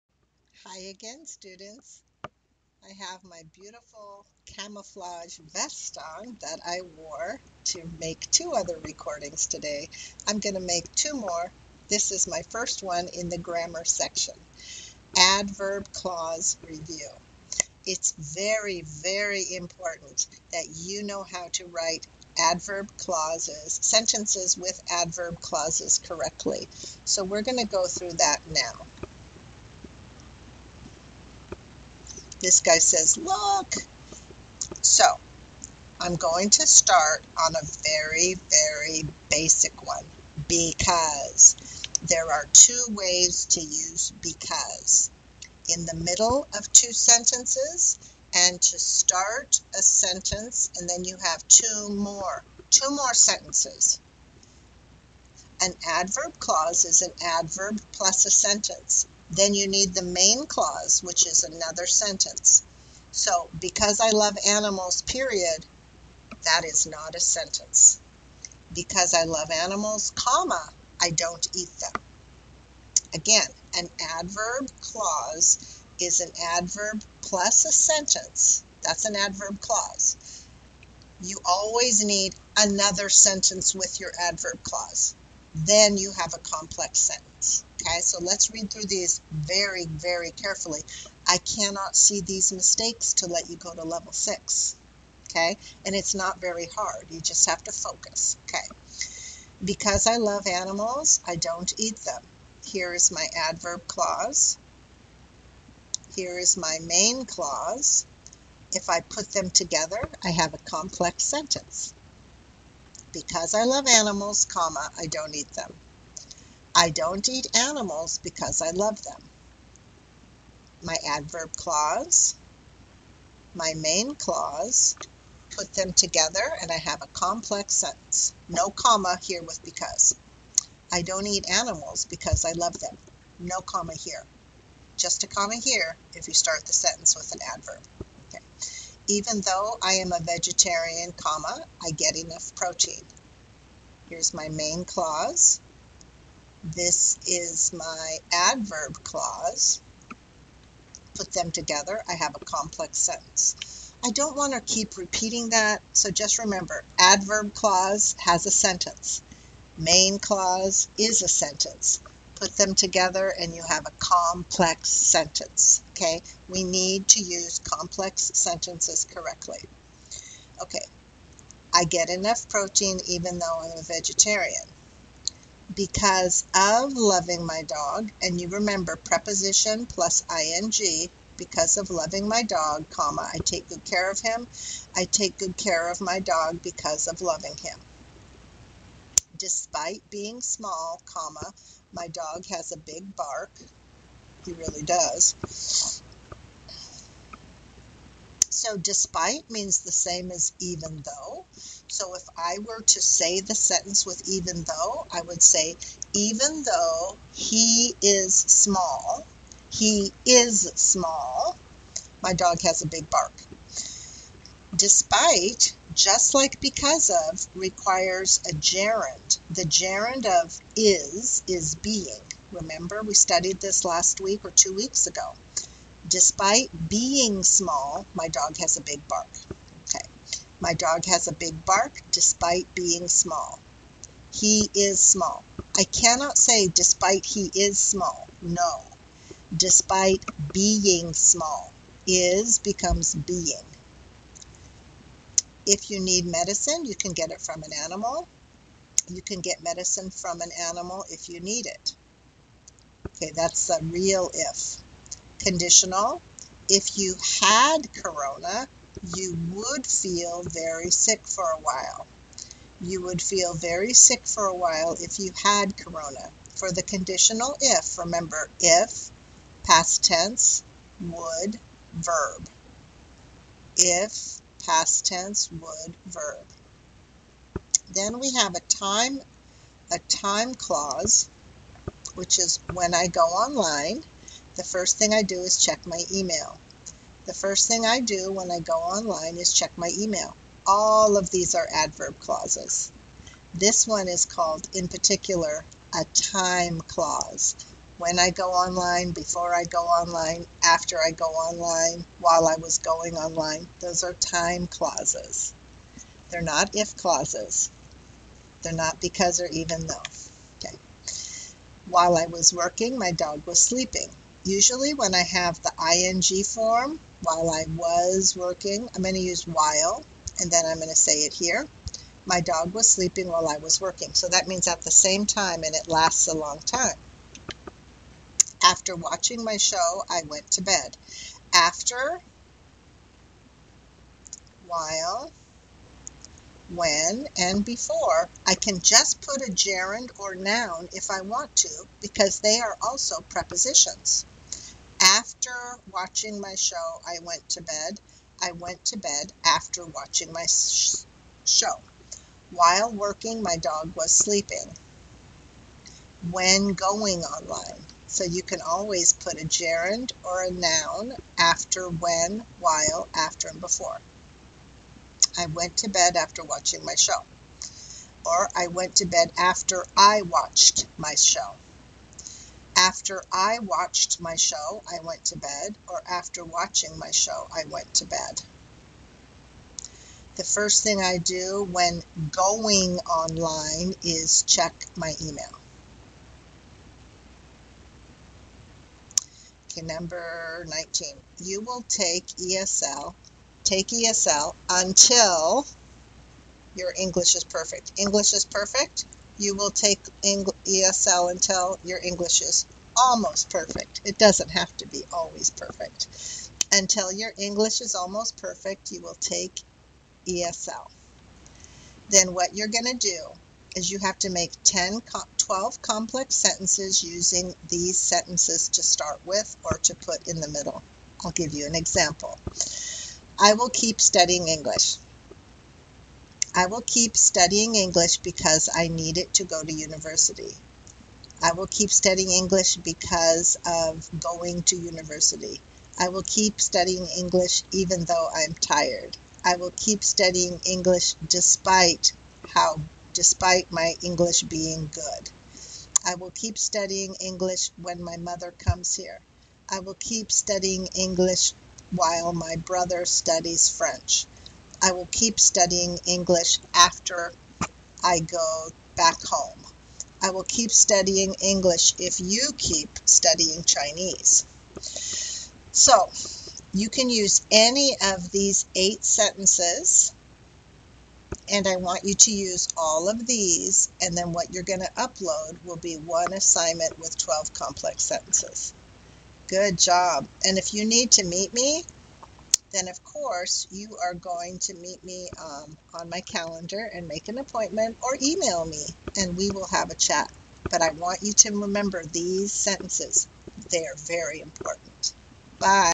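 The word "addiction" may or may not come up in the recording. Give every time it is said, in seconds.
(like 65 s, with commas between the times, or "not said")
not said.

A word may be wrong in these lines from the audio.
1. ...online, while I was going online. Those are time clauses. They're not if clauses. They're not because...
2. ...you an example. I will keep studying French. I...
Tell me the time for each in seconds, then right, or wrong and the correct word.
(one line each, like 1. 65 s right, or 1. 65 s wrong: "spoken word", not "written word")
1. 301 s right
2. 421 s wrong: "English", not "French".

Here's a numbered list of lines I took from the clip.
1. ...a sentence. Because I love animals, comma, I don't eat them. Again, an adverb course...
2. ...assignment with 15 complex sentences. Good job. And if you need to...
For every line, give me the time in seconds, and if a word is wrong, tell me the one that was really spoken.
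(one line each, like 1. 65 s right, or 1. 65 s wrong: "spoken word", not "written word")
1. 67 s wrong: "clause", not "course"
2. 476 s wrong: "12", not "15".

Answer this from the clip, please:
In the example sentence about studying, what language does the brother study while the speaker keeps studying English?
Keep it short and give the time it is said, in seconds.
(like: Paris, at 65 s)
French, at 453 s.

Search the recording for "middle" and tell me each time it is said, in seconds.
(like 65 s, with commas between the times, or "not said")
45 s, 420 s.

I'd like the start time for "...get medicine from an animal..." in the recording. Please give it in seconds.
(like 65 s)
249 s.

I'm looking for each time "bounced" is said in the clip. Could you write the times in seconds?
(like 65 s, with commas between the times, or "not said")
not said.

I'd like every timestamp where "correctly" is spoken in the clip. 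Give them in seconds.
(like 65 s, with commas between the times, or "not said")
25 s, 169 s.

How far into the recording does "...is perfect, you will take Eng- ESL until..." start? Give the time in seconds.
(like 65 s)
398 s.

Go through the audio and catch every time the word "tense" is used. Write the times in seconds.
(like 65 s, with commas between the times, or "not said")
270 s, 275 s.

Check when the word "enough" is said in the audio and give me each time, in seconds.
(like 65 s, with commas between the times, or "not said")
142 s, 172 s.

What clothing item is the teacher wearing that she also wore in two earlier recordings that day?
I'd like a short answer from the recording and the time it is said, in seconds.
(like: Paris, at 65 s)
camouflage vest, at 4 s.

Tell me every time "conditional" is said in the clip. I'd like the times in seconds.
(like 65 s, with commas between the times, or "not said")
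255 s, 266 s.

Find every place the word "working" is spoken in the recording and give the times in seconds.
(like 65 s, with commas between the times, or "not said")
312 s, 318 s, 323 s, 352 s.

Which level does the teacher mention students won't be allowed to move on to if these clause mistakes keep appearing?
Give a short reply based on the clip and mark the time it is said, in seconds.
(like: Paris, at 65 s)
level 6, at 93 s.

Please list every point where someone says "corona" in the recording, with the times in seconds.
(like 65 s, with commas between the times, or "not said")
257 s, 265 s.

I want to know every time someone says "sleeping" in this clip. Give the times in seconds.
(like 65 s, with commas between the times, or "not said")
313 s, 322 s, 354 s.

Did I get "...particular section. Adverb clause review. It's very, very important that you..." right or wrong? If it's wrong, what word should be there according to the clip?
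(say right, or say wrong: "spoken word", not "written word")
wrong: "grammar", not "particular".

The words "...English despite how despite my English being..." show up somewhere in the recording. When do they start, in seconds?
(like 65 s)
440 s.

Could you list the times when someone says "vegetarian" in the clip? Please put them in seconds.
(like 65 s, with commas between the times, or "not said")
140 s, 173 s.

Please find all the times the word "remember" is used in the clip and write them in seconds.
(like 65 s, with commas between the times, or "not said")
156 s, 178 s, 222 s, 267 s, 491 s.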